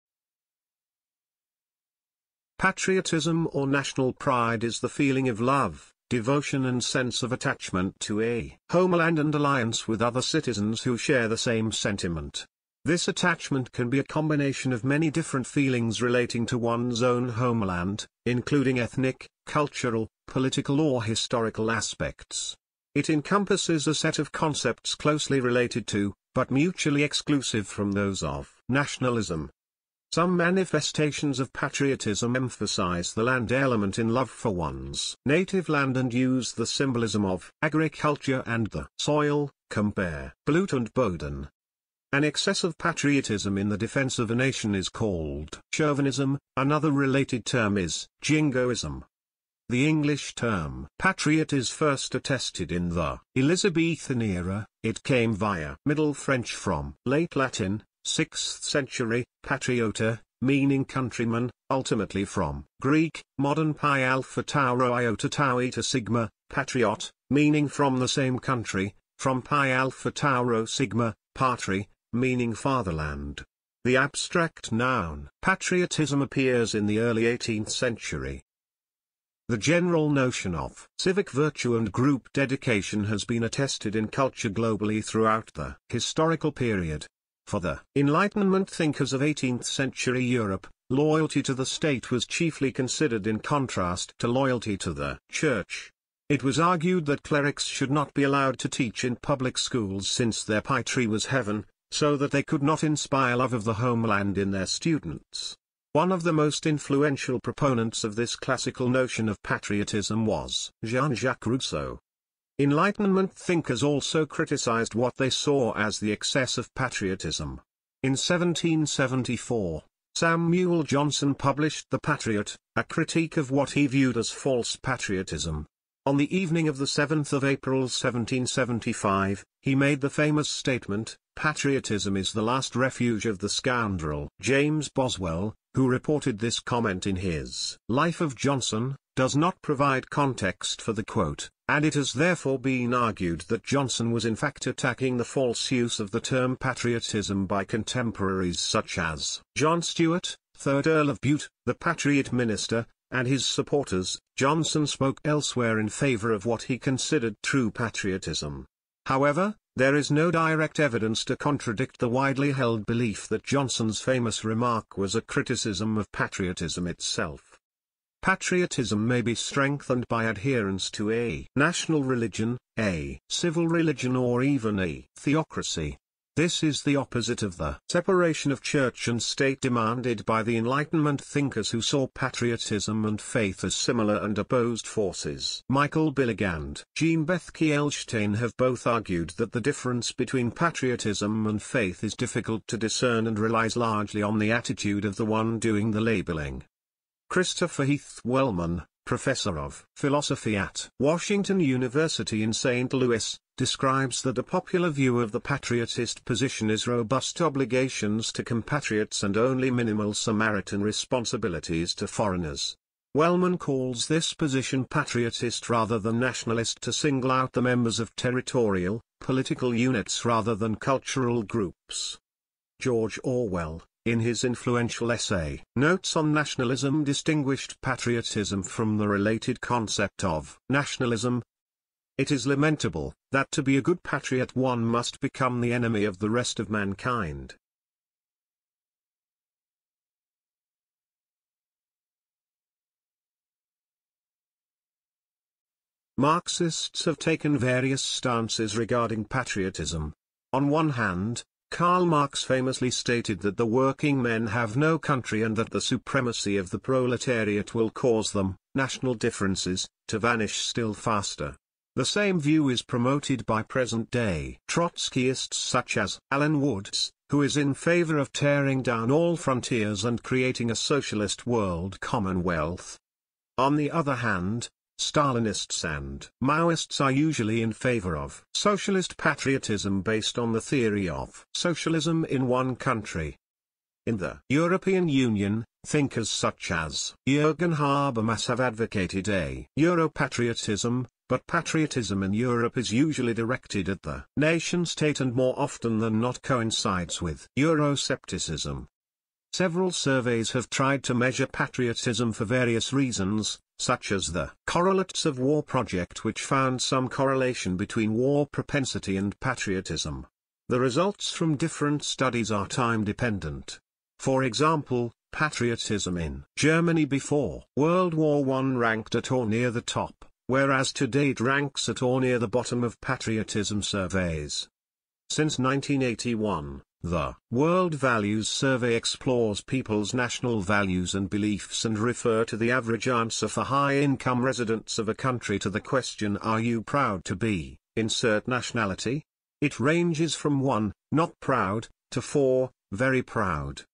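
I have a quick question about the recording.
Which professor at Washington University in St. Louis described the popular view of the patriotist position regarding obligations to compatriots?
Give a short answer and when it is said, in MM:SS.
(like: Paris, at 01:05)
Christopher Heath Wellman, at 03:17.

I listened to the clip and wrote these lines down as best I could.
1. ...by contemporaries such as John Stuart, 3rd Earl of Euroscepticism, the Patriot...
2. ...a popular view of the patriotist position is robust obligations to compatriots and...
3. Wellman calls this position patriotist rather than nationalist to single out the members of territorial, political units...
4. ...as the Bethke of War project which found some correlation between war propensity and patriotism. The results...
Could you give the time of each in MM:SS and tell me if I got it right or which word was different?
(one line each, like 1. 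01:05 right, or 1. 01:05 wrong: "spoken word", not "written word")
1. 02:27 wrong: "Bute", not "Euroscepticism"
2. 03:24 right
3. 03:33 right
4. 05:04 wrong: "Correlates", not "Bethke".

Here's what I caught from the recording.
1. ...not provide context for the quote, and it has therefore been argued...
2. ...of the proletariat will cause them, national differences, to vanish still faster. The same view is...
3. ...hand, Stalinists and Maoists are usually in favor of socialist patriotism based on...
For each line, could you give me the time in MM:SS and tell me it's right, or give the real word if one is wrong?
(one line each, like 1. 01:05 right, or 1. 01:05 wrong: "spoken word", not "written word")
1. 02:19 right
2. 04:16 right
3. 04:34 right.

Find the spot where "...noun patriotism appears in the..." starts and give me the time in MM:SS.
01:14.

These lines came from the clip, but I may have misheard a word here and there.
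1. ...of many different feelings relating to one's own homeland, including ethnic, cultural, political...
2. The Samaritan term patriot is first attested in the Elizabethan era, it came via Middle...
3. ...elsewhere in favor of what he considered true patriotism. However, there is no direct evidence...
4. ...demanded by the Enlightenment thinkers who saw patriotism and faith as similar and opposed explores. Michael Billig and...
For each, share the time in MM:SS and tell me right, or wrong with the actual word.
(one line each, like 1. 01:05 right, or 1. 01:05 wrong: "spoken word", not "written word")
1. 00:14 right
2. 00:49 wrong: "English", not "Samaritan"
3. 02:35 right
4. 02:59 wrong: "forces", not "explores".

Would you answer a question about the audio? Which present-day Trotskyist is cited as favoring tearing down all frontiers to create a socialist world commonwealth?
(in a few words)
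Alan Woods.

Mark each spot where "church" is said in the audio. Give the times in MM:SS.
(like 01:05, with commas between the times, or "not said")
01:35, 02:58.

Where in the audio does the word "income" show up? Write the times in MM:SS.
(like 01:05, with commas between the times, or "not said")
05:33.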